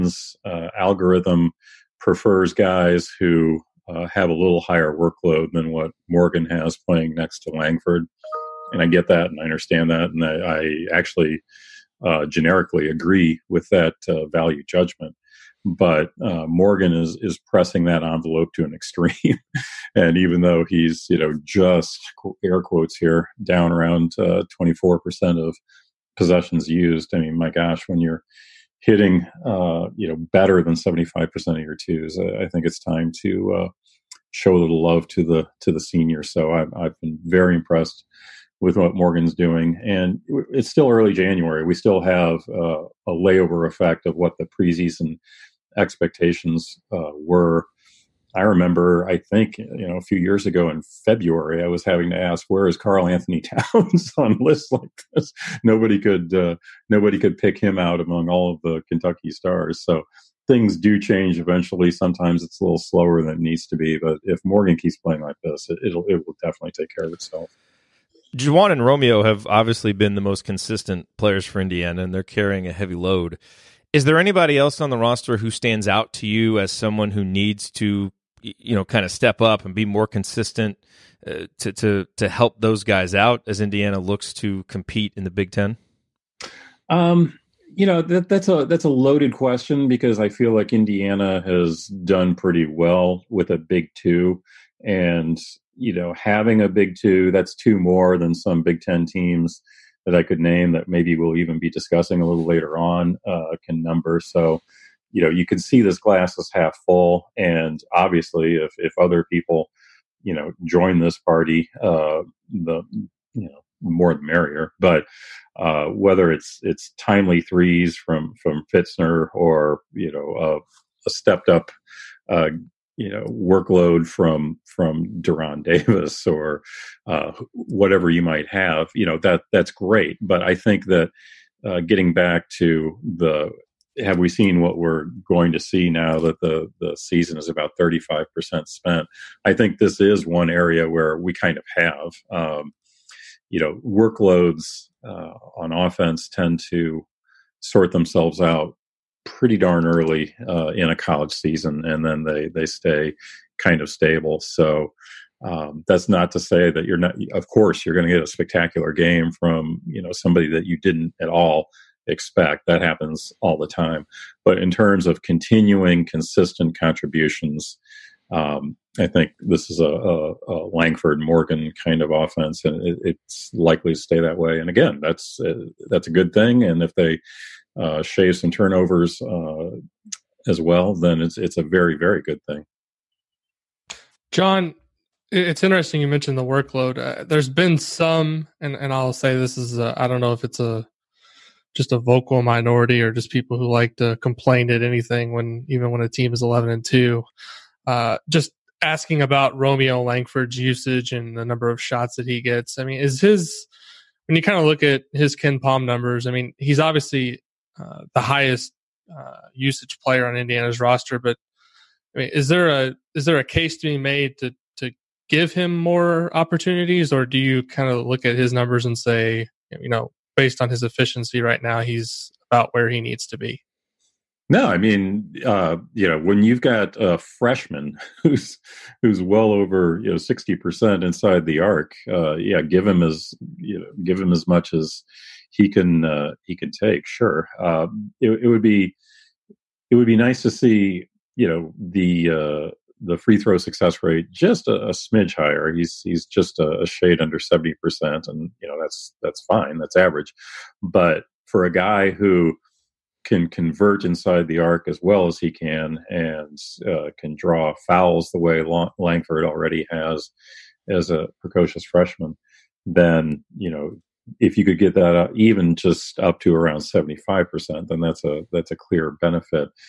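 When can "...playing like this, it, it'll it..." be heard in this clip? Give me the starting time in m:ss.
1:04.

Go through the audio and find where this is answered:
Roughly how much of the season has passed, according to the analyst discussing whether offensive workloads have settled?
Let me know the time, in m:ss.
2:17.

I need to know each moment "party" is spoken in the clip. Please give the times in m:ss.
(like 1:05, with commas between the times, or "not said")
1:51.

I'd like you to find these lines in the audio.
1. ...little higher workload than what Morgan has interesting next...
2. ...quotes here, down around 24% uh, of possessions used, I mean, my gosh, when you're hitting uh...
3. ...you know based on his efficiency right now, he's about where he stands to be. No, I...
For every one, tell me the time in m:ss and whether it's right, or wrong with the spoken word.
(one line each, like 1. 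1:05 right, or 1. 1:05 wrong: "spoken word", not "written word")
1. 0:04 wrong: "playing", not "interesting"
2. 0:22 right
3. 3:39 wrong: "needs", not "stands".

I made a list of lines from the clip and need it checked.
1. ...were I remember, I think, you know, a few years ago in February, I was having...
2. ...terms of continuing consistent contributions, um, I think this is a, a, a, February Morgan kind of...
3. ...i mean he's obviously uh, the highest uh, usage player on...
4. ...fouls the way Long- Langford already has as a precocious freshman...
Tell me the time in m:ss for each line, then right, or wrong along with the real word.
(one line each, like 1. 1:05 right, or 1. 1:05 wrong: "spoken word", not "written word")
1. 0:47 right
2. 2:44 wrong: "Langford", not "February"
3. 3:26 right
4. 4:17 right.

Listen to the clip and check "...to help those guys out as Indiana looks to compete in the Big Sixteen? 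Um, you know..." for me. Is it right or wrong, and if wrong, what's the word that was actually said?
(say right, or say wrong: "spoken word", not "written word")
wrong: "Ten", not "Sixteen".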